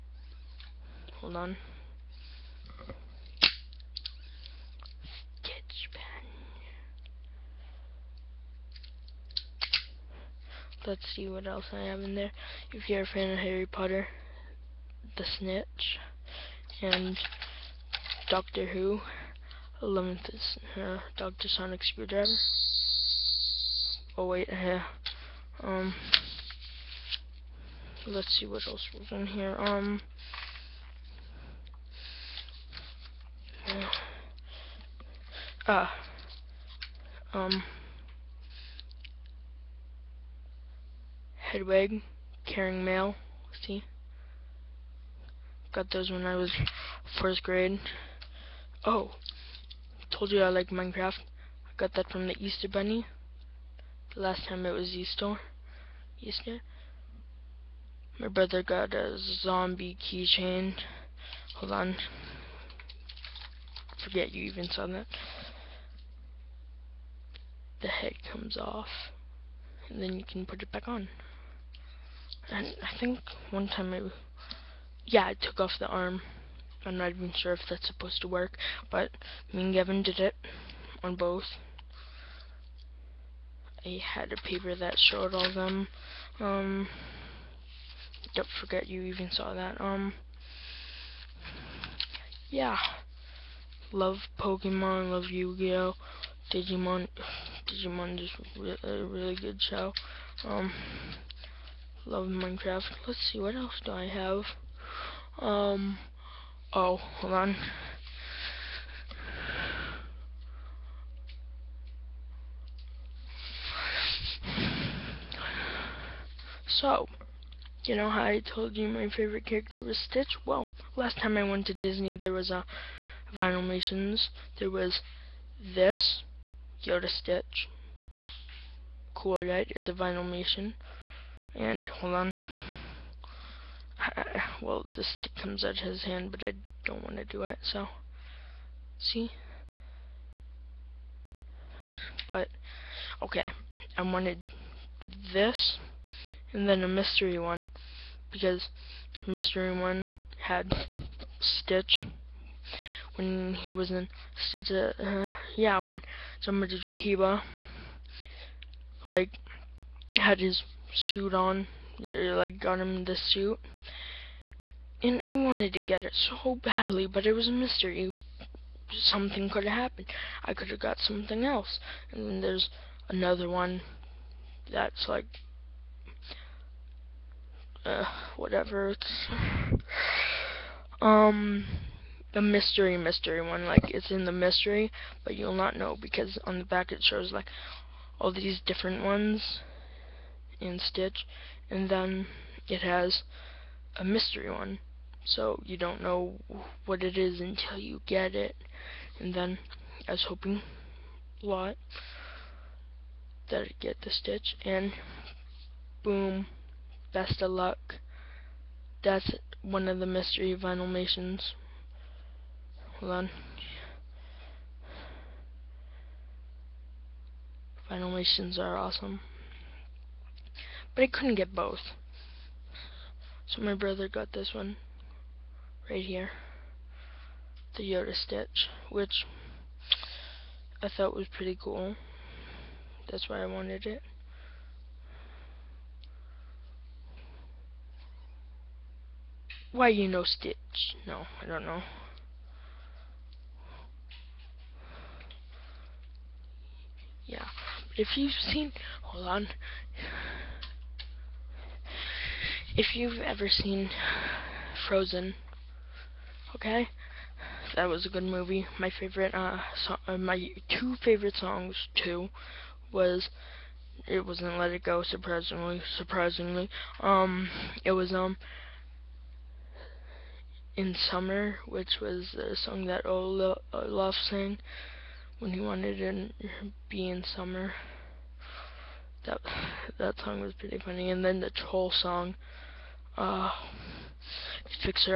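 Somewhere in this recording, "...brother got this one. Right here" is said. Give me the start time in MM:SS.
03:43.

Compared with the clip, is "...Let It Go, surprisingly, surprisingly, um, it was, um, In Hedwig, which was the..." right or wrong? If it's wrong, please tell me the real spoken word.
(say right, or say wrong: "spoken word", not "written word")
wrong: "Summer", not "Hedwig".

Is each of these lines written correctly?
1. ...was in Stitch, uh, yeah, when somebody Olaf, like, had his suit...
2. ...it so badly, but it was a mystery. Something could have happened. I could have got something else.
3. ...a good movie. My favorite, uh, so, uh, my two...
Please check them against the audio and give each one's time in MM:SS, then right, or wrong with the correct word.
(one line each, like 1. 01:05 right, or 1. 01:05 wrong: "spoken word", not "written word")
1. 02:33 wrong: "Kiba", not "Olaf"
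2. 02:46 right
3. 04:18 right.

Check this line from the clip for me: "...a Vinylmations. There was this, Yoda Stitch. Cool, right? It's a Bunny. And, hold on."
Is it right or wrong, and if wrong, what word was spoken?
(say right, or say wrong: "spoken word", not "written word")
wrong: "Vinylmation", not "Bunny".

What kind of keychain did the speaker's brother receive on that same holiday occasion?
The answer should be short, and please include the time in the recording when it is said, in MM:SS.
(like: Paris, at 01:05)
Zombie keychain, at 00:59.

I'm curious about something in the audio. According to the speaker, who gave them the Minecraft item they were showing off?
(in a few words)
The Easter Bunny.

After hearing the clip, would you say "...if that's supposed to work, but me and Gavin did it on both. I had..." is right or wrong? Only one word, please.
right.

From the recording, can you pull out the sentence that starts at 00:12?
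If you're a fan of Harry Potter, the snitch and Doctor Who, 11th is uh, Doctor Sonic Screwdriver.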